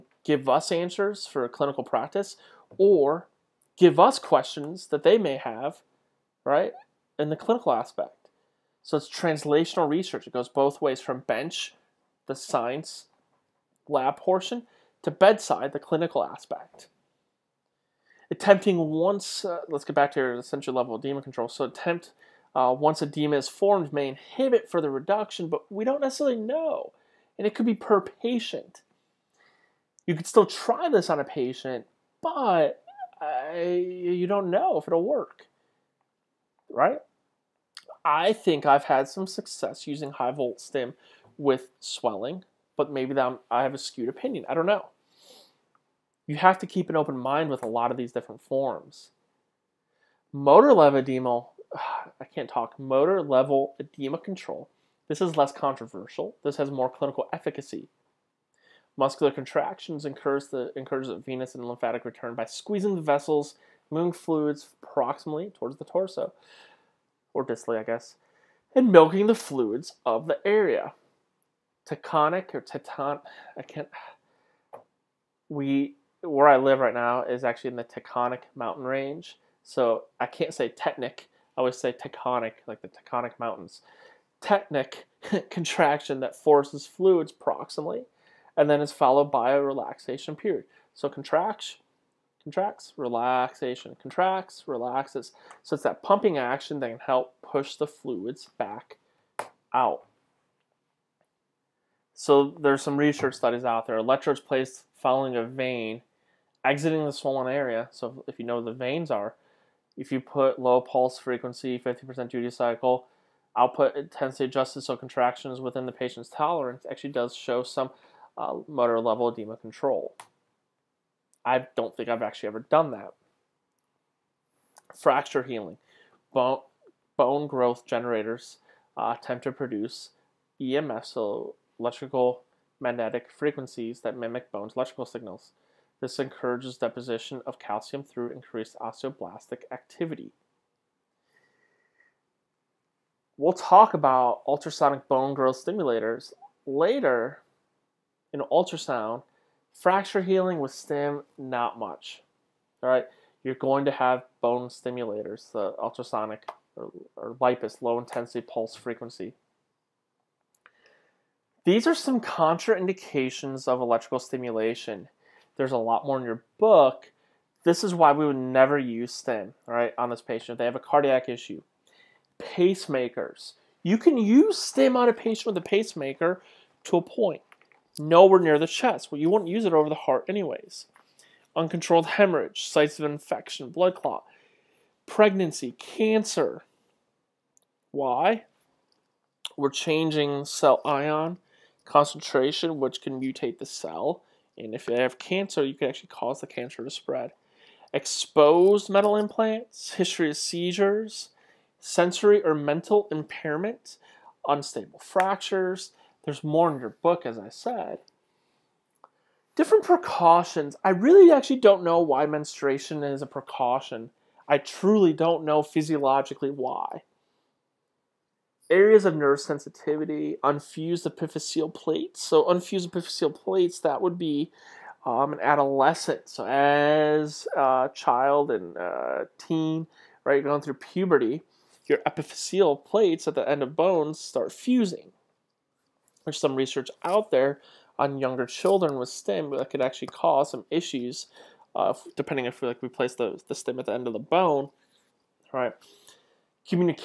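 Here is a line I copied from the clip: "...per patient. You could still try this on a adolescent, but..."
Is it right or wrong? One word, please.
wrong.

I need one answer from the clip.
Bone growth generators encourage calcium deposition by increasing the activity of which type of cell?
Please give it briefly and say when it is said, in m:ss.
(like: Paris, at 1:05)
Osteoblastic, at 2:18.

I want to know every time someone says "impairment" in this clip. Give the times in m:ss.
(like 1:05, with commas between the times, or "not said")
3:23.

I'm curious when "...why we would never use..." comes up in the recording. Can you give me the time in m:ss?
2:47.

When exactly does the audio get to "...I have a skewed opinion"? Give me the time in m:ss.
0:43.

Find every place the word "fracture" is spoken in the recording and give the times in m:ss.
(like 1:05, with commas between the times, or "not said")
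2:04, 2:29, 3:25.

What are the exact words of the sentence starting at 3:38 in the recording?
Areas of nerve sensitivity, unfused epiphyseal plates.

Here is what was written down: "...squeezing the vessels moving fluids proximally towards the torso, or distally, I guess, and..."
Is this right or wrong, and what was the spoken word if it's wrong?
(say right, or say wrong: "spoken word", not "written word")
right.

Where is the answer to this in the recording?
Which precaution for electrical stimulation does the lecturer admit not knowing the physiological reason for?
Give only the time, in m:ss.
3:32.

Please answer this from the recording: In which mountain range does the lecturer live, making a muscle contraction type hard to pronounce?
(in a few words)
Taconic mountain range.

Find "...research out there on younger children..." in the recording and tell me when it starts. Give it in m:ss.
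3:56.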